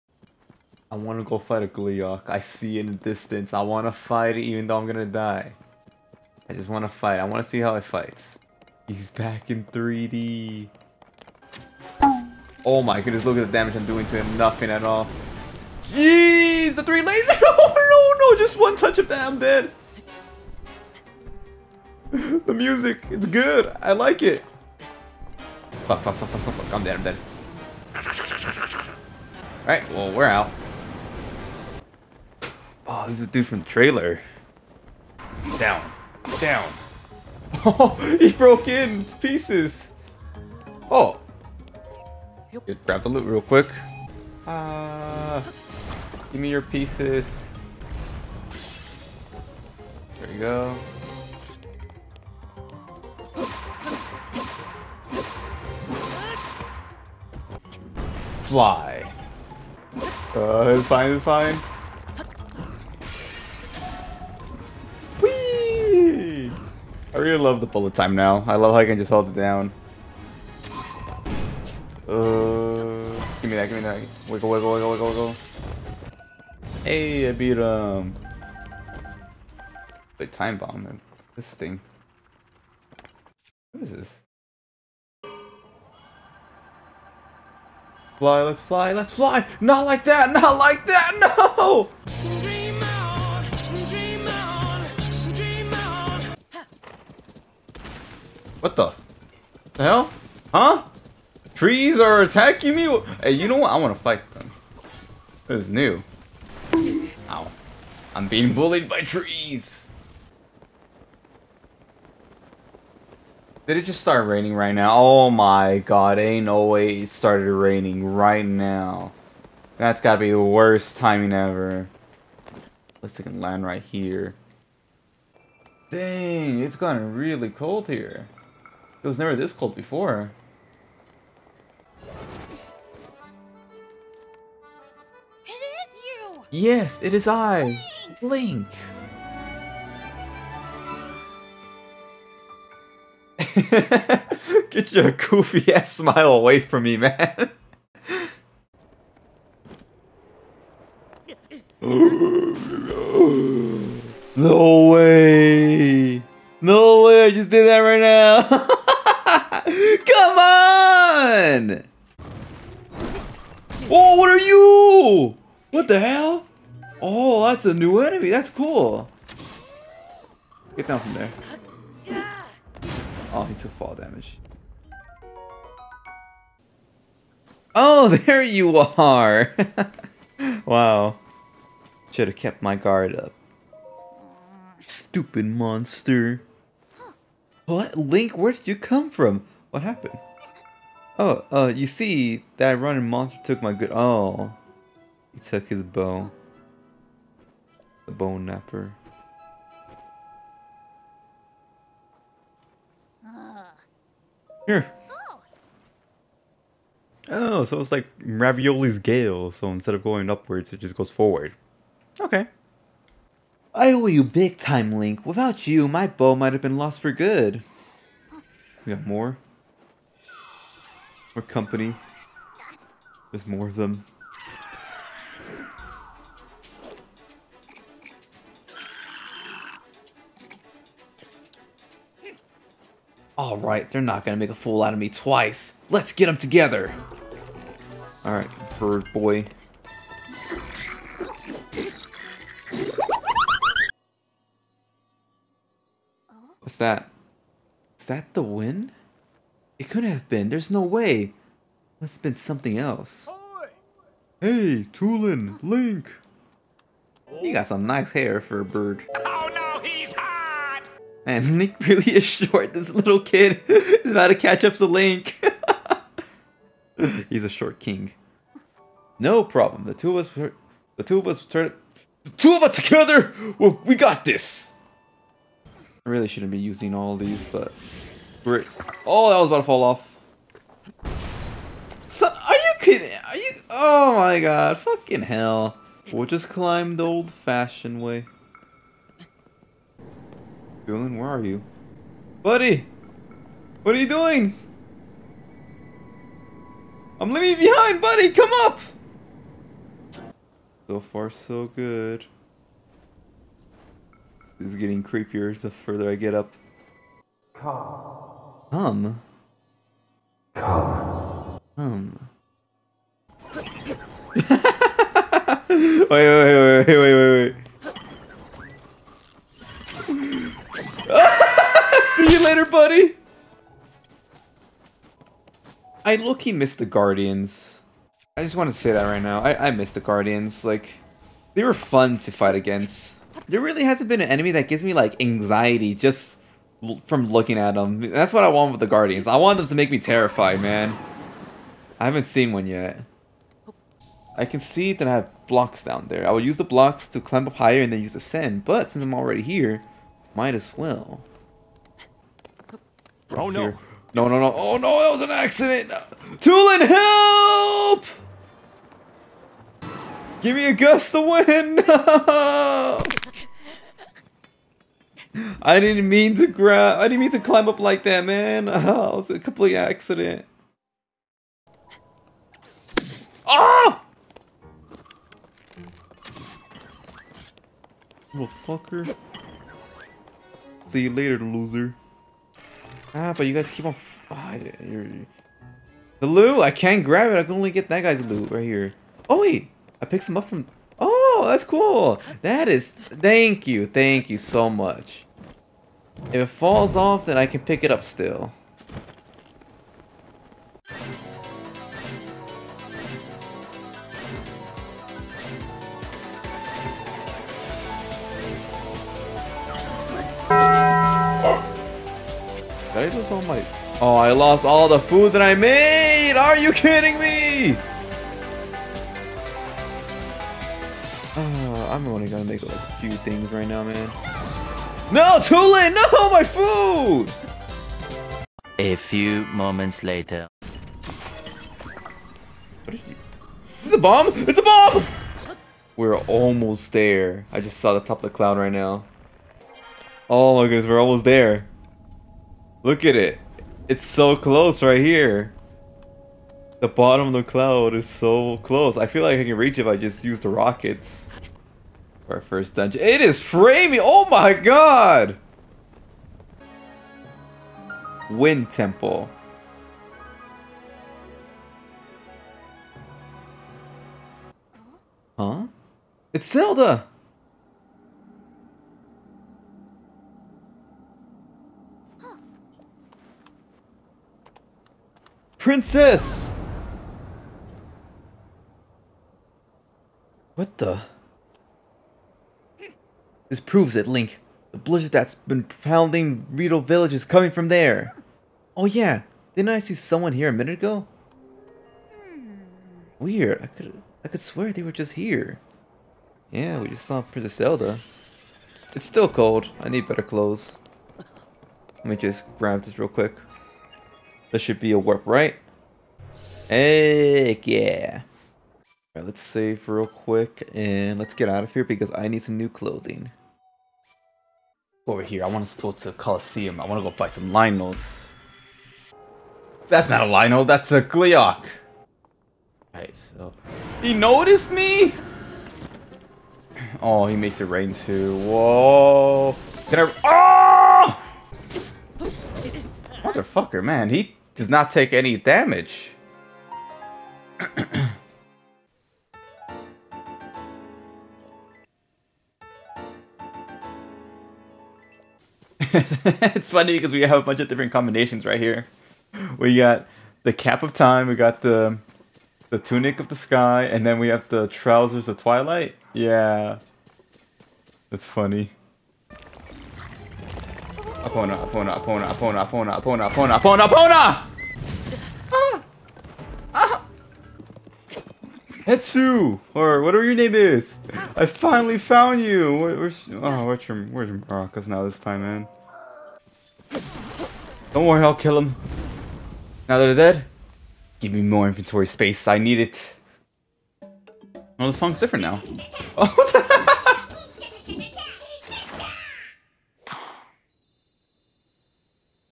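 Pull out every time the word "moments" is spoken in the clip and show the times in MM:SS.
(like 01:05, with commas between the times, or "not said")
07:09.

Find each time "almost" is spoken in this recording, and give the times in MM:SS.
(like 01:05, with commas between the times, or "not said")
07:16, 07:21.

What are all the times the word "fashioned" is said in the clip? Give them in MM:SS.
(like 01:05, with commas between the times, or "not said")
04:47.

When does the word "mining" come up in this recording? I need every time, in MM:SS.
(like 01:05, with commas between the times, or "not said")
not said.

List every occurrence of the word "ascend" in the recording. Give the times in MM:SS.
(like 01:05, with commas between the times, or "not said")
05:48.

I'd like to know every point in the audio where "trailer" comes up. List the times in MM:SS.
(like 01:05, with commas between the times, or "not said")
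00:33.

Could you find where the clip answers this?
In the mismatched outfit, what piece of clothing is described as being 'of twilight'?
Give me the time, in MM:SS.
09:14.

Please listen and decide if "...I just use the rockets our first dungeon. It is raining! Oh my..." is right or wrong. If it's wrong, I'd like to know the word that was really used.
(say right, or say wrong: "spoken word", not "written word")
wrong: "framing", not "raining".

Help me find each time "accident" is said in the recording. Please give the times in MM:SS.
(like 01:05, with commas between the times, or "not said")
05:55, 06:09.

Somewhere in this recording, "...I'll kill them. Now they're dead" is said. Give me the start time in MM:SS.
09:38.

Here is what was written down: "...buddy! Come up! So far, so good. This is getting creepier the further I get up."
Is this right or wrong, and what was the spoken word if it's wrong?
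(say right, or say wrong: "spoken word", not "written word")
right.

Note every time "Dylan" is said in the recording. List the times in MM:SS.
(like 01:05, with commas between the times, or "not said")
04:50.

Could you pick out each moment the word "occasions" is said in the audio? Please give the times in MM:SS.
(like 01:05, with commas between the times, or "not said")
not said.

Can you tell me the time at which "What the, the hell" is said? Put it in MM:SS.
01:38.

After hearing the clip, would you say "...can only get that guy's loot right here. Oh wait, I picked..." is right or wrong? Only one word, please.
right.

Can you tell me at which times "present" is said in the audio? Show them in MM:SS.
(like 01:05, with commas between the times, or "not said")
not said.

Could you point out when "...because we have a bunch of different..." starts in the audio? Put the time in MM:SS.
09:06.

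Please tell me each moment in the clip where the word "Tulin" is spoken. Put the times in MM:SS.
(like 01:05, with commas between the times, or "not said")
04:14, 05:56.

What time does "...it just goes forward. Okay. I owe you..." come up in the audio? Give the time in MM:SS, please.
03:30.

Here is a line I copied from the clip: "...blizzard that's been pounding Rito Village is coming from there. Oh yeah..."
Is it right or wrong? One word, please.
right.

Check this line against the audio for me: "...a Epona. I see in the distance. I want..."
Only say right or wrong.
wrong.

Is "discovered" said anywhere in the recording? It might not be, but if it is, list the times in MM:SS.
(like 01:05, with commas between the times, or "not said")
not said.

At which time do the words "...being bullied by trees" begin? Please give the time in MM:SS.
01:48.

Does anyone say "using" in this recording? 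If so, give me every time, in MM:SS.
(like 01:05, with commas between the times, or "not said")
04:36.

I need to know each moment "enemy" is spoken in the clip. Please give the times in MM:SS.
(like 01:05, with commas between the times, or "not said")
02:48, 05:34.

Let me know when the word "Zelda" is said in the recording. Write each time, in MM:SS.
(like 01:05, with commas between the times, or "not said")
07:46, 08:17.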